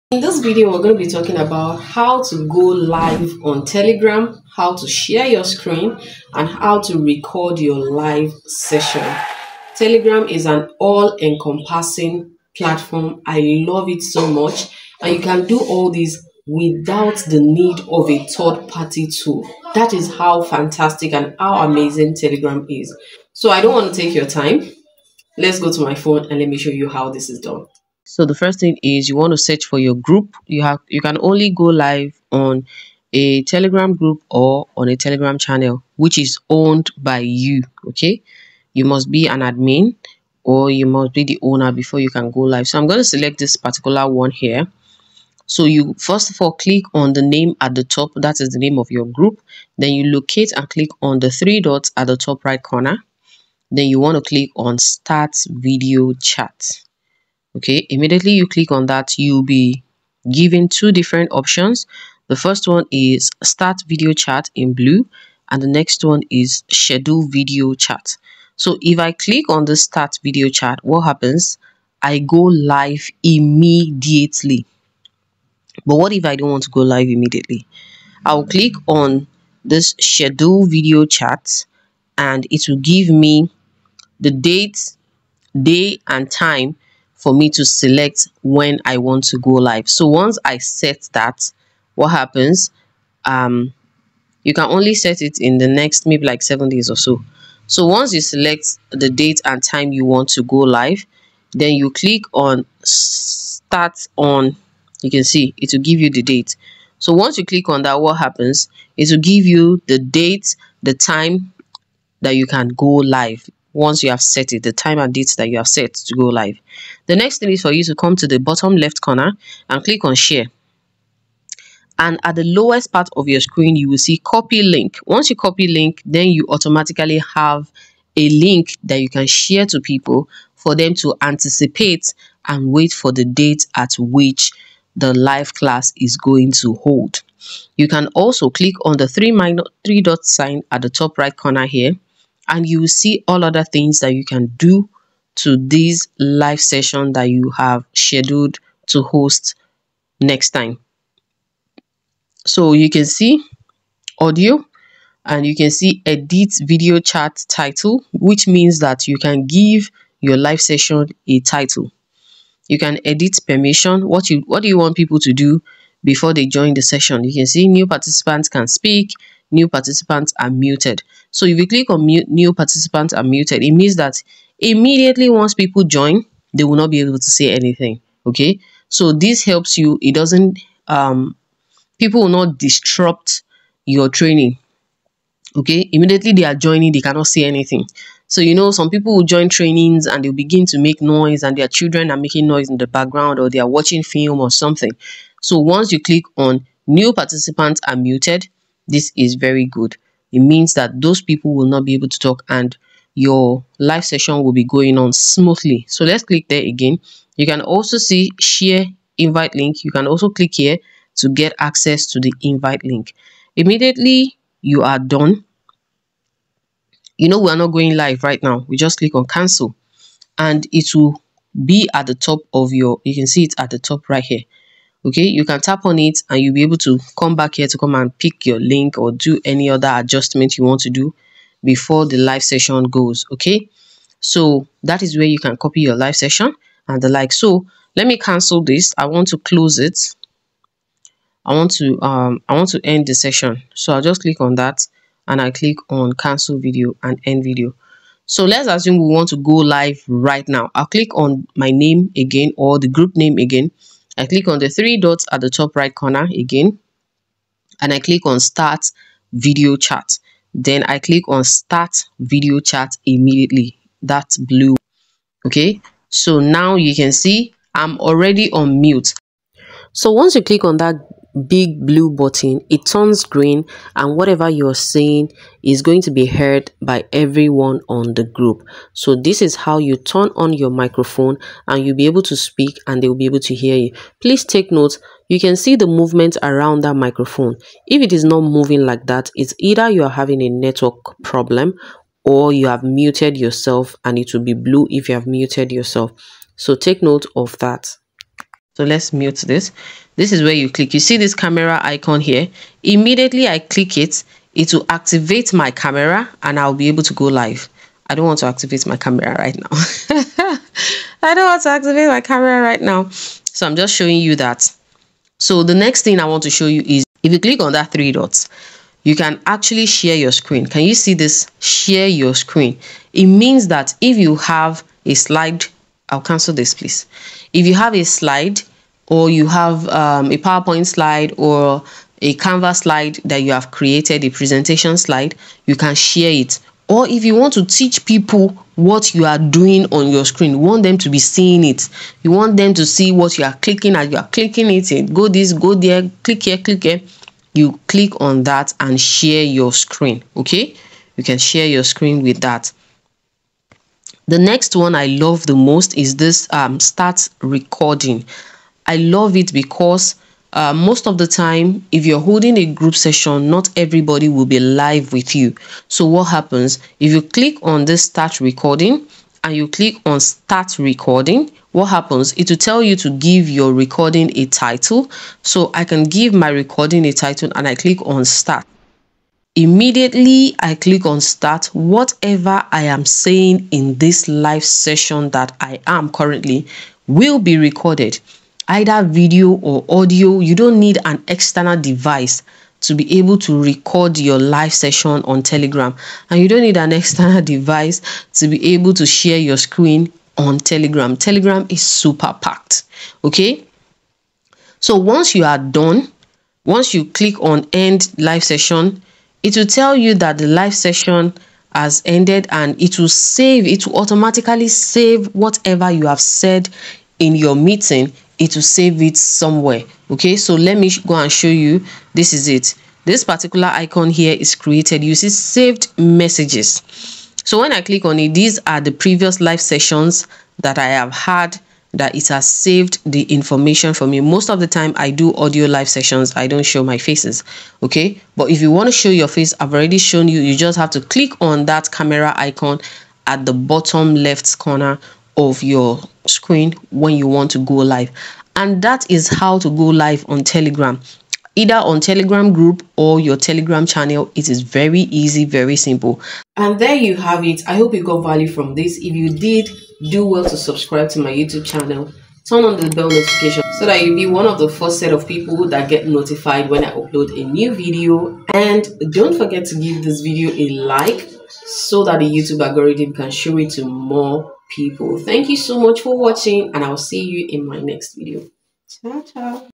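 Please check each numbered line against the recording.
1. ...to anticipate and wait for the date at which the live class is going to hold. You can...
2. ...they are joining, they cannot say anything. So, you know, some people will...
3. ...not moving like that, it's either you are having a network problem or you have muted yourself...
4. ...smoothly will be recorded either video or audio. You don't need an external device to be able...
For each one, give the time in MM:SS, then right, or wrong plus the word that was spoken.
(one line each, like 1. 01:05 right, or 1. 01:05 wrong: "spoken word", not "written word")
1. 02:10 right
2. 03:06 right
3. 04:48 right
4. 06:26 wrong: "currently", not "smoothly".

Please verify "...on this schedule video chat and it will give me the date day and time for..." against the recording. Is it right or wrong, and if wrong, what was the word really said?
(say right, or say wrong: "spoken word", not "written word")
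right.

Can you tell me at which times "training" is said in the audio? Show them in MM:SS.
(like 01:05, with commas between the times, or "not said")
03:04, 03:09.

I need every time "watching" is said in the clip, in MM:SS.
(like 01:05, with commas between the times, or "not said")
03:13, 07:56.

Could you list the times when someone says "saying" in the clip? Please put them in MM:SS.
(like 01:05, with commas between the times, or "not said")
04:34, 06:23.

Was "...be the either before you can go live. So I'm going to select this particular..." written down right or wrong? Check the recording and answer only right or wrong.
wrong.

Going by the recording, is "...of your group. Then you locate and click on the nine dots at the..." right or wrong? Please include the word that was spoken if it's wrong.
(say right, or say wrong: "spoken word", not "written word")
wrong: "three", not "nine".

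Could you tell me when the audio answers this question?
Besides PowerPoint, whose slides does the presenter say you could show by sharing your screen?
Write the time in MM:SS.
05:32.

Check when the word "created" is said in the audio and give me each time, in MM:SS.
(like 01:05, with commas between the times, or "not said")
05:33, 07:04.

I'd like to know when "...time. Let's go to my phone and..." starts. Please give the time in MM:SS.
00:24.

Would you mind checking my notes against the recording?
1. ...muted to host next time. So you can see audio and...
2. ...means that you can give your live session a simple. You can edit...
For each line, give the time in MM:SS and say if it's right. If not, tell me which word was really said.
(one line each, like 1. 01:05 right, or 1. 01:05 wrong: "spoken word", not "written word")
1. 02:27 wrong: "scheduled", not "muted"
2. 02:38 wrong: "title", not "simple".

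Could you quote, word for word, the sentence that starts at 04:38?
So this is how you turn on your microphone and you'll be able to speak and they'll be able to hear you.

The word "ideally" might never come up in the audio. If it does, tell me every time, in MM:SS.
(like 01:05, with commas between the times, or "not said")
not said.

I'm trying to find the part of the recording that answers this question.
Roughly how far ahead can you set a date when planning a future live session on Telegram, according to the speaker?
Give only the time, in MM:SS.
01:36.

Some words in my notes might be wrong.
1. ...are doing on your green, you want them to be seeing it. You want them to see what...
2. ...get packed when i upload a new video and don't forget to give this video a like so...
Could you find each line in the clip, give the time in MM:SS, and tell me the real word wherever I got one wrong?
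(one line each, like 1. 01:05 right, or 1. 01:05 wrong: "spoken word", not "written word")
1. 05:39 wrong: "screen", not "green"
2. 07:45 wrong: "notified", not "packed".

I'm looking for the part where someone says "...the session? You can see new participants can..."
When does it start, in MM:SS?
02:46.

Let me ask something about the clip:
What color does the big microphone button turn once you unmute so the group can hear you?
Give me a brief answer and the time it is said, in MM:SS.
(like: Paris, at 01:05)
Green, at 04:33.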